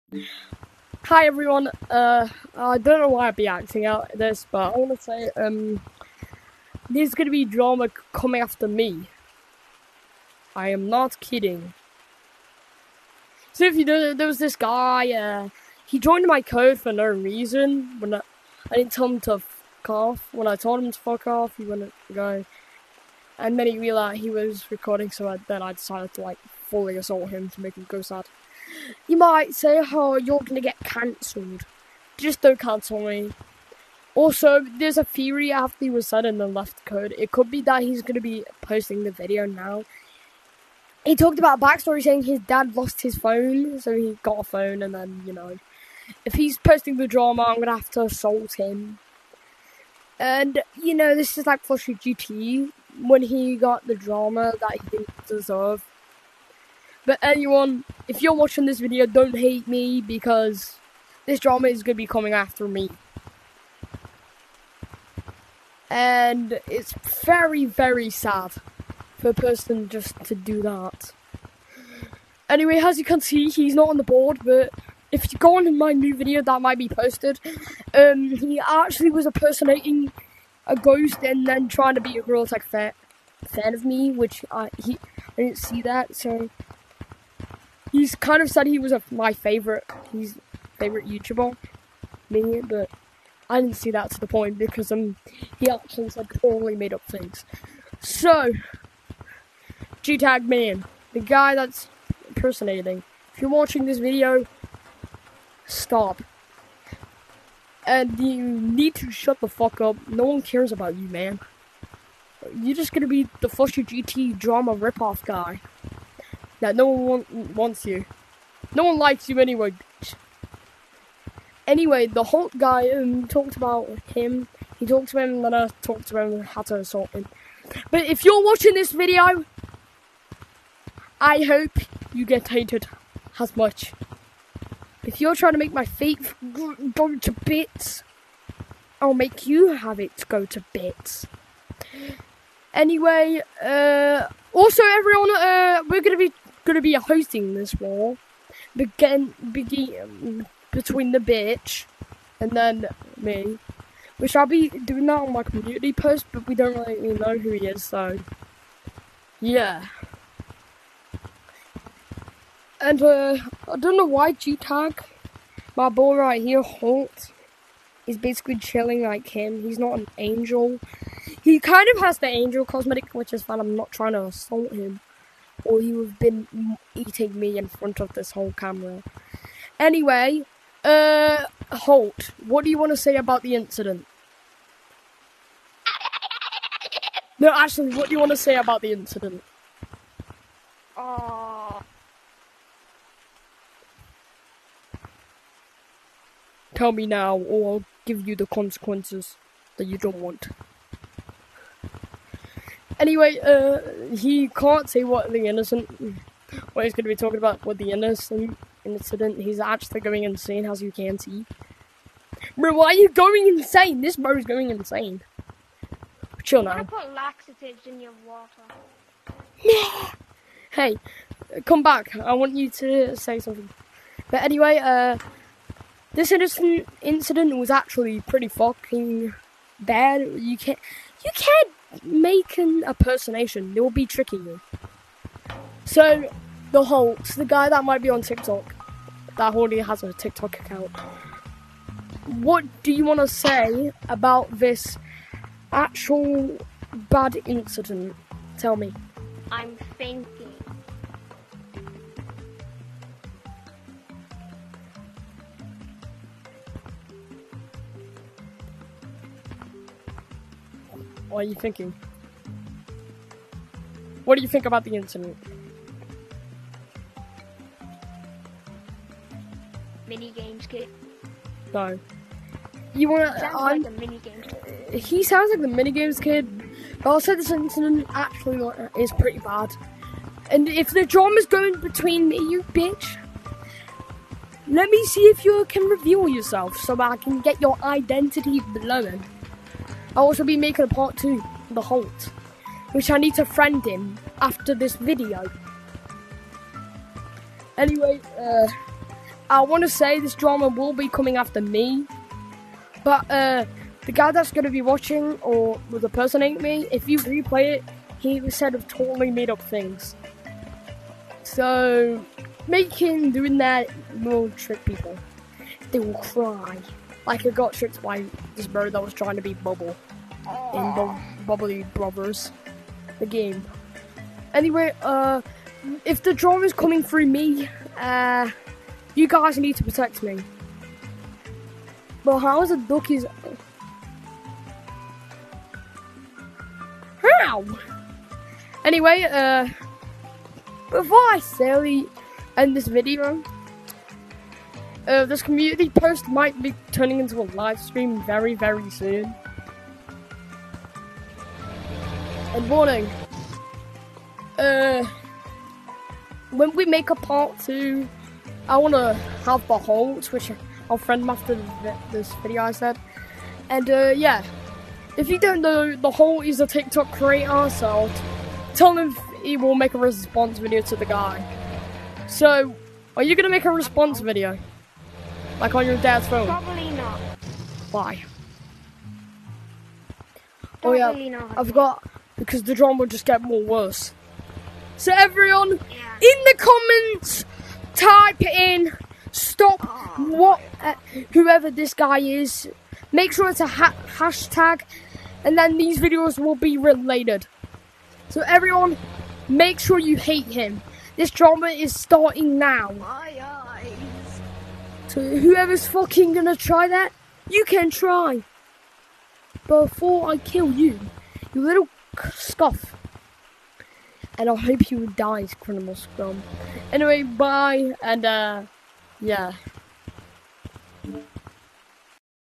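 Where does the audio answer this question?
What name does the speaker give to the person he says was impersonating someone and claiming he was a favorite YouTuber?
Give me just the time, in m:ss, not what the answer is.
1:40.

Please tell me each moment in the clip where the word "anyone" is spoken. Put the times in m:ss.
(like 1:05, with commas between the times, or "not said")
0:57.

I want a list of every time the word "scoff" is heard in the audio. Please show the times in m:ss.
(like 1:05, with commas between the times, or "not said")
6:52.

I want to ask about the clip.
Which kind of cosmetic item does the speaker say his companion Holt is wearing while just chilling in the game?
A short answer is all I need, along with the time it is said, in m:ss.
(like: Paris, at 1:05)
Angel cosmetic, at 2:52.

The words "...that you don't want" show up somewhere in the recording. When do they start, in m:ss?
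3:19.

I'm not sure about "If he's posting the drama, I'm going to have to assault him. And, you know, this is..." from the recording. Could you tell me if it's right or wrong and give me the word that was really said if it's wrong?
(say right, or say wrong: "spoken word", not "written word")
right.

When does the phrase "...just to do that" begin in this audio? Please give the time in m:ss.
1:09.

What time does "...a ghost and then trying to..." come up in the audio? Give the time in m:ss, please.
1:20.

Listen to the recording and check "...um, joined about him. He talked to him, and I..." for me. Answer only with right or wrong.
wrong.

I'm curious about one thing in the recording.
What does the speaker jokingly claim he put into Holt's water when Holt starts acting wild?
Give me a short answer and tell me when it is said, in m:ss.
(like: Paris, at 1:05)
Laxatives, at 3:37.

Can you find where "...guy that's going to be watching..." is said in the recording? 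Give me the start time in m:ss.
5:04.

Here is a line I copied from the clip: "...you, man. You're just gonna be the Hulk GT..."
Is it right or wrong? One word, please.
wrong.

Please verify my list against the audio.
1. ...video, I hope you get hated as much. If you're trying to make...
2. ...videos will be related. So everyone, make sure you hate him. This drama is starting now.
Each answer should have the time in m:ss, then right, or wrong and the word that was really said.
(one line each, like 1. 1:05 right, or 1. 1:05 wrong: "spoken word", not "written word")
1. 2:08 right
2. 6:35 right.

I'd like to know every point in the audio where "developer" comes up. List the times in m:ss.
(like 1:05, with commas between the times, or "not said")
not said.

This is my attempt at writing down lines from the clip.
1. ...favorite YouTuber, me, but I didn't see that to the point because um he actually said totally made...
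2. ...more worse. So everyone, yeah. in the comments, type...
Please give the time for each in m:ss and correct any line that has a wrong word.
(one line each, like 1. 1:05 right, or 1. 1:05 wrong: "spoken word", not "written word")
1. 1:30 right
2. 6:23 right.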